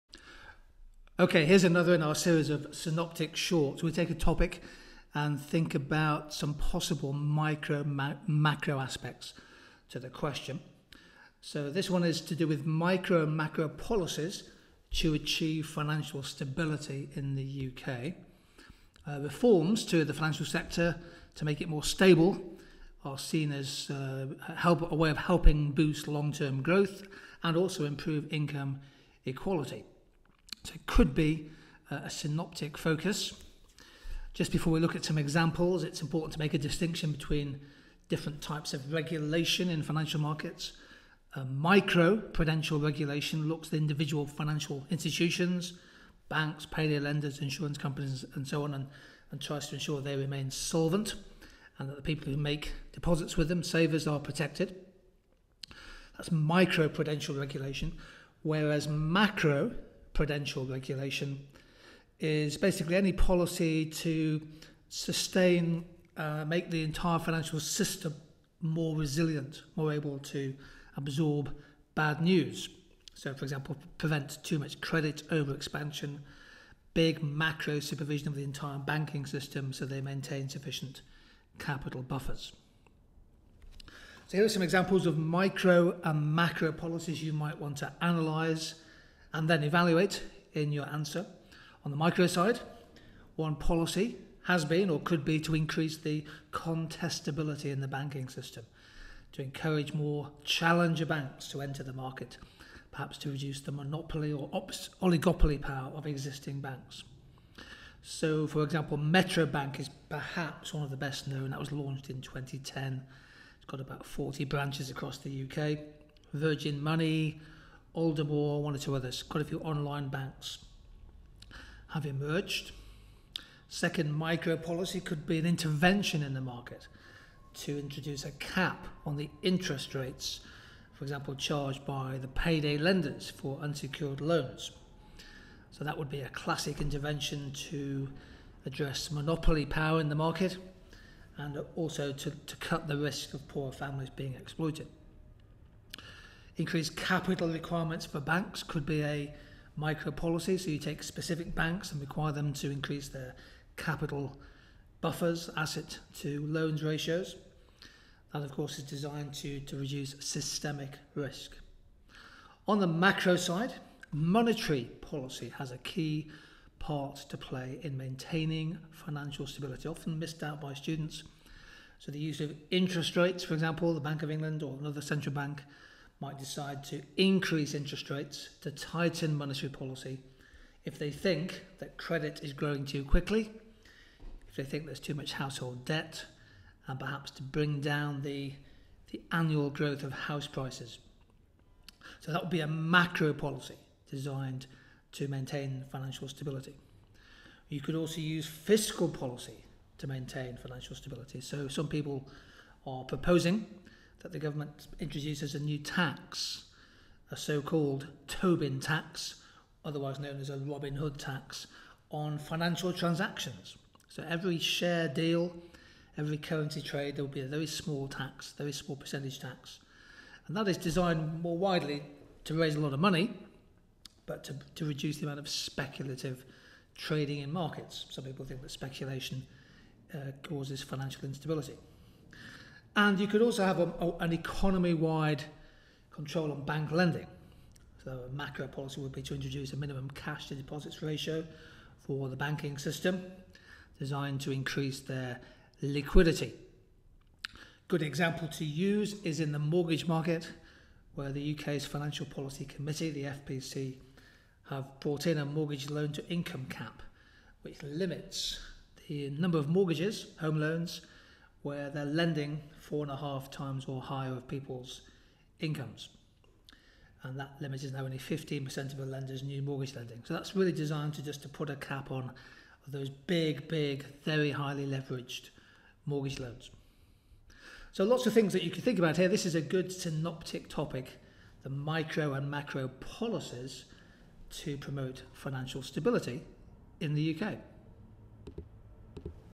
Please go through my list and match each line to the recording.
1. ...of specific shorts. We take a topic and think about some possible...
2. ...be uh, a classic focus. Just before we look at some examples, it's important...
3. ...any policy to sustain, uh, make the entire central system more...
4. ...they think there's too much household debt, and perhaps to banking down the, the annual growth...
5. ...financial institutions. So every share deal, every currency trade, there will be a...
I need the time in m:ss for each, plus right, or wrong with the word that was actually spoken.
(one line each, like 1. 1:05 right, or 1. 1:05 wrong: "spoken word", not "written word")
1. 0:02 wrong: "synoptic", not "specific"
2. 0:31 wrong: "synoptic", not "classic"
3. 1:02 wrong: "financial", not "central"
4. 3:04 wrong: "bring", not "banking"
5. 3:32 wrong: "transactions", not "institutions".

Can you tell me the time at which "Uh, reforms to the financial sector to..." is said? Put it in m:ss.
0:19.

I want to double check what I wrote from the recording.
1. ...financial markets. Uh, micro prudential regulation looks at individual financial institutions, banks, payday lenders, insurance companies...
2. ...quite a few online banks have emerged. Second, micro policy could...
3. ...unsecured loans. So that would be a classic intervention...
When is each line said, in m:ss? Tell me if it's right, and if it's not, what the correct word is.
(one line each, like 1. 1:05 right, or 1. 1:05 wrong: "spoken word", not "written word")
1. 0:39 right
2. 1:59 right
3. 2:13 right.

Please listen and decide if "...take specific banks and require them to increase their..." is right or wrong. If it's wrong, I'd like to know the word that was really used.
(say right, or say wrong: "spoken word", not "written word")
right.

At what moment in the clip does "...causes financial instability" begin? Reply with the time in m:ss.
3:50.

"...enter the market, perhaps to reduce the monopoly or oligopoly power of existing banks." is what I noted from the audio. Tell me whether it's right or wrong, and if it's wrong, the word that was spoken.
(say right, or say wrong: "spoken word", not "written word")
right.